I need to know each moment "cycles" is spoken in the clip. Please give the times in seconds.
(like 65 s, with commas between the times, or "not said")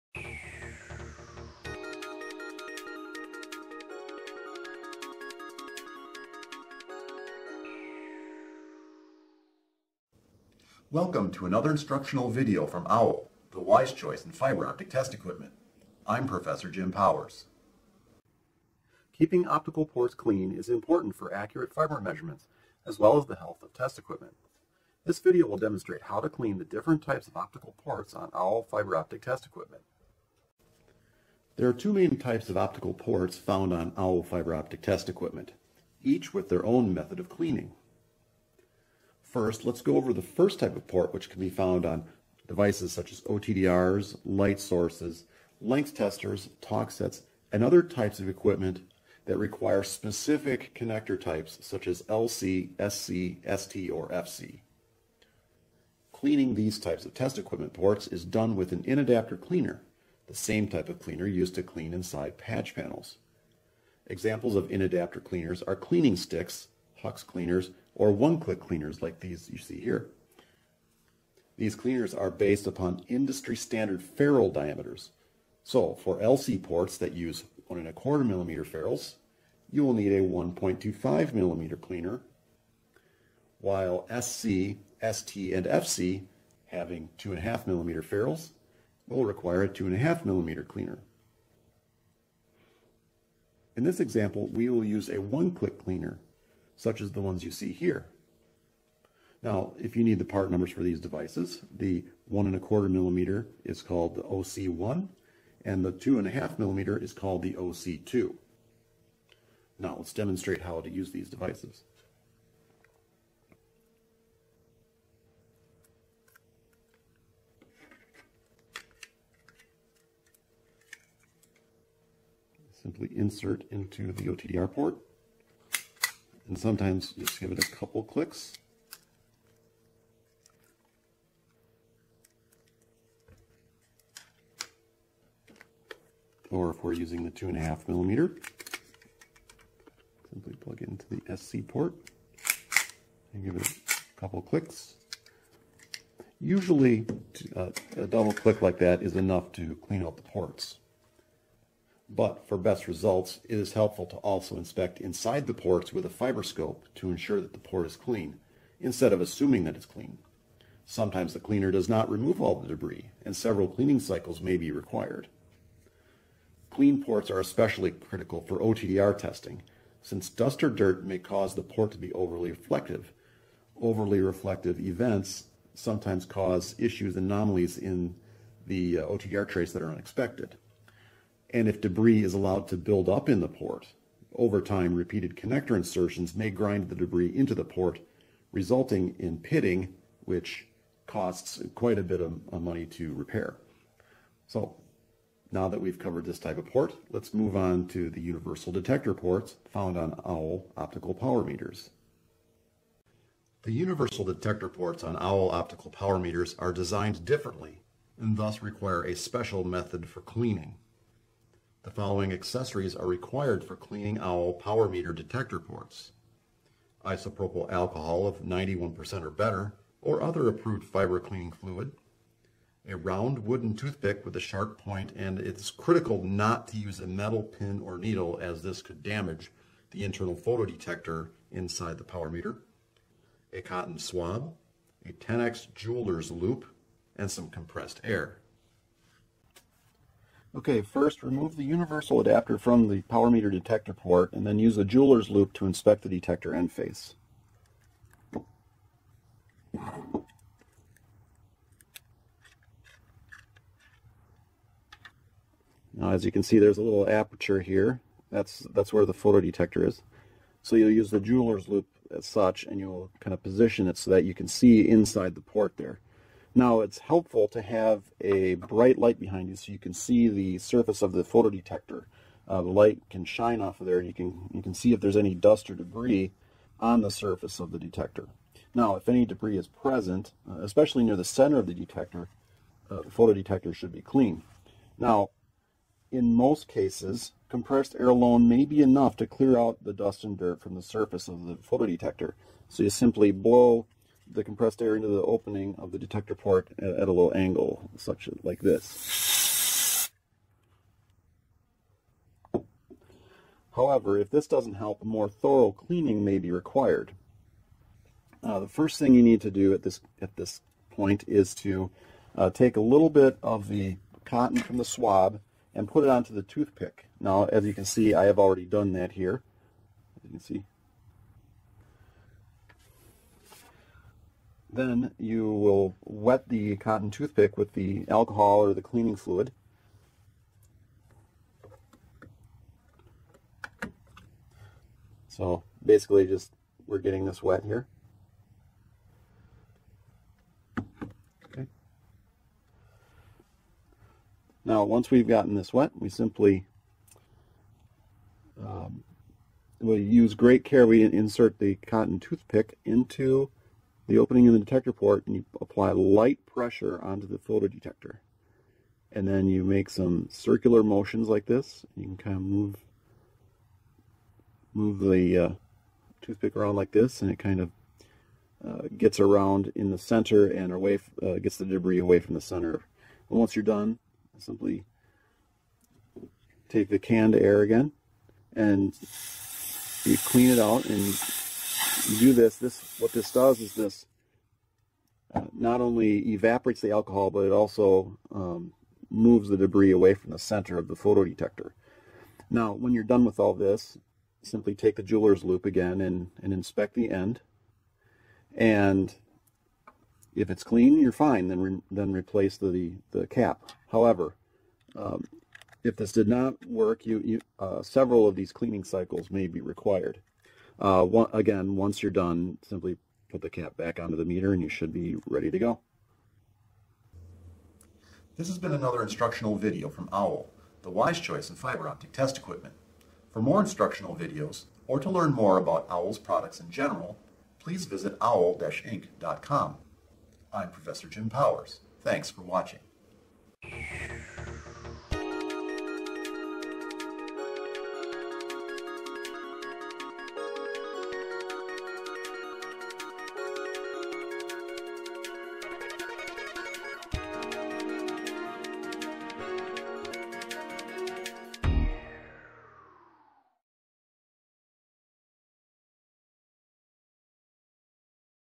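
163 s, 408 s.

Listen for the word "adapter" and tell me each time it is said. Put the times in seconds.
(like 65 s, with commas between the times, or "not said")
58 s, 64 s, 242 s.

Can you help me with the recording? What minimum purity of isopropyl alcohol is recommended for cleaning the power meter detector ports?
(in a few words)
91%.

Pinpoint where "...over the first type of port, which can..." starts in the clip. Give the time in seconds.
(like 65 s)
39 s.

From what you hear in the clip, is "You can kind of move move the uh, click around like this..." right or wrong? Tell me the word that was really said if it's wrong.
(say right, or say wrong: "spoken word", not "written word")
wrong: "toothpick", not "click".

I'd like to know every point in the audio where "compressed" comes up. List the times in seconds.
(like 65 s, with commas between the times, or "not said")
237 s, 287 s, 294 s.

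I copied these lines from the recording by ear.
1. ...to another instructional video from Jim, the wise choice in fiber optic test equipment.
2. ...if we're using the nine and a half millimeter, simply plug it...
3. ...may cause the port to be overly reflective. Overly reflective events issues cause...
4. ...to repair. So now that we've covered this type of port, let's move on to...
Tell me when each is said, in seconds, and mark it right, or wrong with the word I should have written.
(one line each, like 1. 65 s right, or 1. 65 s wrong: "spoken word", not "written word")
1. 11 s wrong: "OWL", not "Jim"
2. 136 s wrong: "two", not "nine"
3. 171 s wrong: "sometimes", not "issues"
4. 192 s right.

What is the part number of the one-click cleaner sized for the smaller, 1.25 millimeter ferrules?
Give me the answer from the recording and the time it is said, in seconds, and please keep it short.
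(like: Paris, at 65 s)
OC1, at 104 s.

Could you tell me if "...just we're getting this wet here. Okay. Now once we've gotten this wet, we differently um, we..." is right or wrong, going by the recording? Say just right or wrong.
wrong.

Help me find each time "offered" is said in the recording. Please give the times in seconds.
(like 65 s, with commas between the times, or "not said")
not said.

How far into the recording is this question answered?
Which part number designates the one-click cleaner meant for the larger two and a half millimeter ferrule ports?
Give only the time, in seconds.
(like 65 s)
107 s.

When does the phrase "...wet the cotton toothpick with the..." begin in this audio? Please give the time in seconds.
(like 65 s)
326 s.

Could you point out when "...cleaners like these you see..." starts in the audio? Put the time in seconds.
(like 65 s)
68 s.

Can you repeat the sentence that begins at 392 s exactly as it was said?
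Now, when you're done with all this, simply take the jeweler's loupe again and, and inspect the end.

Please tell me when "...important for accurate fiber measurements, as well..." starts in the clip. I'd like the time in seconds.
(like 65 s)
20 s.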